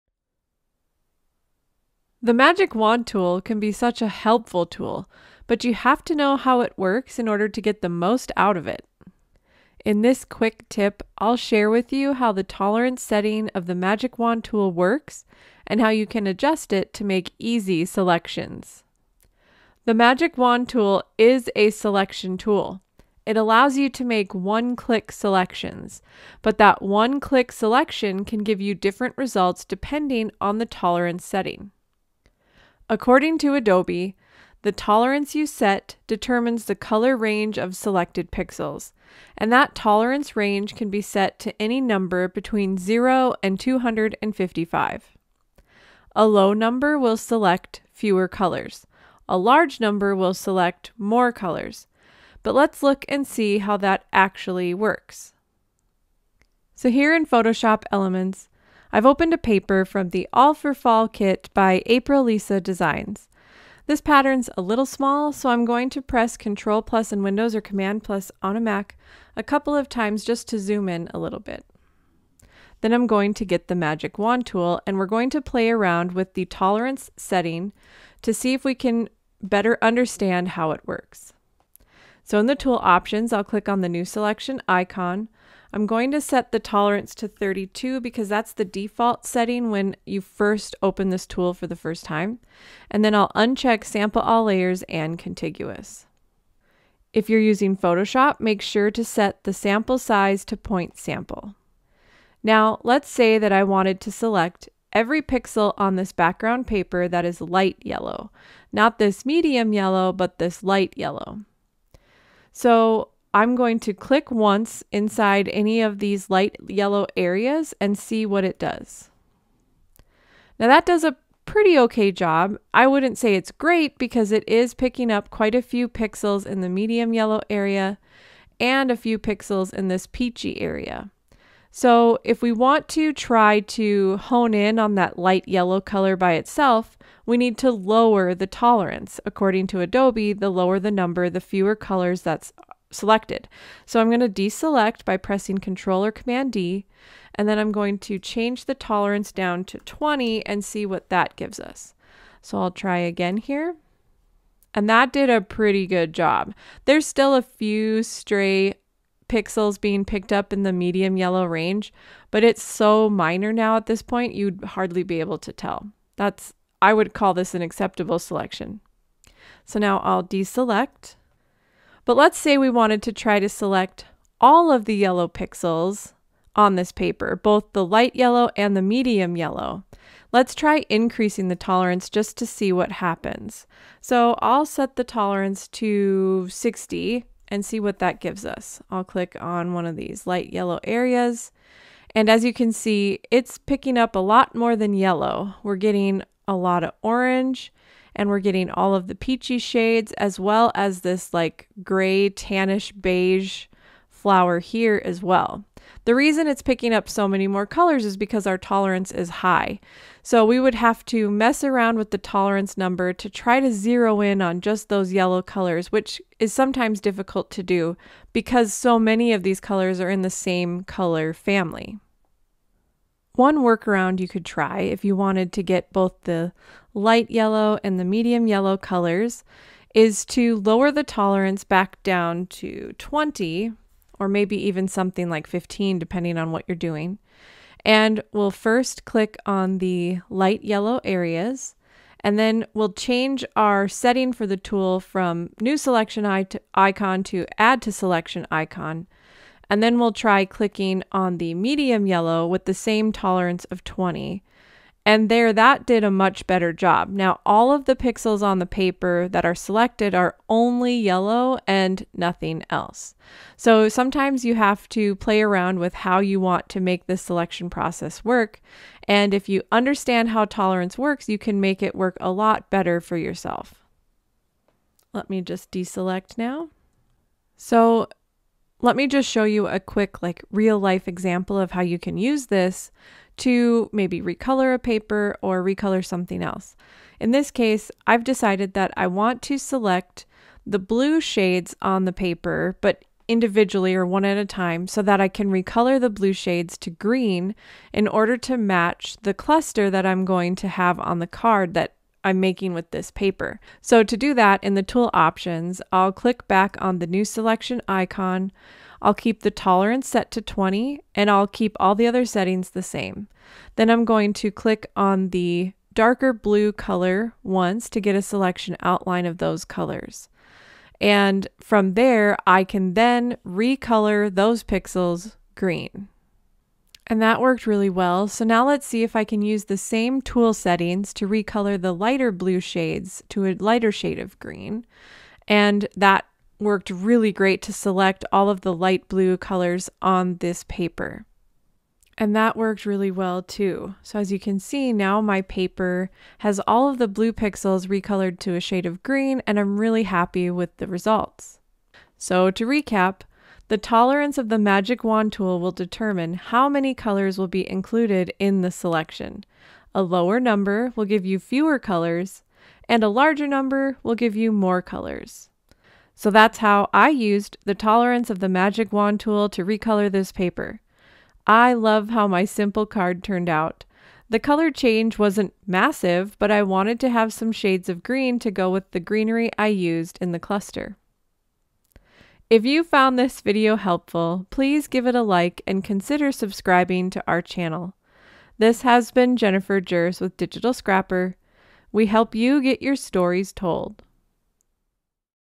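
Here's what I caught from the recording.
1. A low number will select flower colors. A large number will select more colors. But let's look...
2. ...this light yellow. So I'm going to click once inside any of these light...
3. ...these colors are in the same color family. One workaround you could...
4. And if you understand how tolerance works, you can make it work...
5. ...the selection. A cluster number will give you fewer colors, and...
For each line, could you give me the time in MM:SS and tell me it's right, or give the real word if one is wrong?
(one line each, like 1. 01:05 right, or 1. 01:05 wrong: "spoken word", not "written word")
1. 00:46 wrong: "fewer", not "flower"
2. 01:50 right
3. 03:39 right
4. 04:29 right
5. 05:58 wrong: "lower", not "cluster".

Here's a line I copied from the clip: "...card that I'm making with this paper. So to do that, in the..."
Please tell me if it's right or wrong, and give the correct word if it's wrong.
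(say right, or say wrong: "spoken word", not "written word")
right.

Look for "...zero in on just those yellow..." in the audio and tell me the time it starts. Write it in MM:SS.
03:33.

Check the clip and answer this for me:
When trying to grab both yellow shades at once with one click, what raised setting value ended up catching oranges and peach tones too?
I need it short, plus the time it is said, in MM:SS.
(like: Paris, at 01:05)
60, at 03:06.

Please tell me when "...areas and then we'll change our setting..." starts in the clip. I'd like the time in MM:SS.
04:01.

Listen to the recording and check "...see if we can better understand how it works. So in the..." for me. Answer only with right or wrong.
right.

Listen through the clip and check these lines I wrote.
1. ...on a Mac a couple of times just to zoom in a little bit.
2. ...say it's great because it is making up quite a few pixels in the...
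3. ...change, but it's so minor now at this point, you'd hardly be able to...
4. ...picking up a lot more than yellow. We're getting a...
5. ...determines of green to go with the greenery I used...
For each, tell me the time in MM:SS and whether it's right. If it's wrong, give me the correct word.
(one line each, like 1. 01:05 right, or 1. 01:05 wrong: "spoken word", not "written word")
1. 01:08 right
2. 02:03 wrong: "picking", not "making"
3. 02:41 wrong: "range", not "change"
4. 03:13 right
5. 06:17 wrong: "shades", not "determines".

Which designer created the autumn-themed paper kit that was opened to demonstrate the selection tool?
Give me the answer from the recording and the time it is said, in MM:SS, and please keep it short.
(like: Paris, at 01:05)
Aprilisa Designs, at 01:01.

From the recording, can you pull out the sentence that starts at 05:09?
I'll keep the tolerance set to 20 and I'll keep all the other settings the same.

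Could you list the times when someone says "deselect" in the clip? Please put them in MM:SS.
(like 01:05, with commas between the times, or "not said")
02:24, 02:50, 04:35.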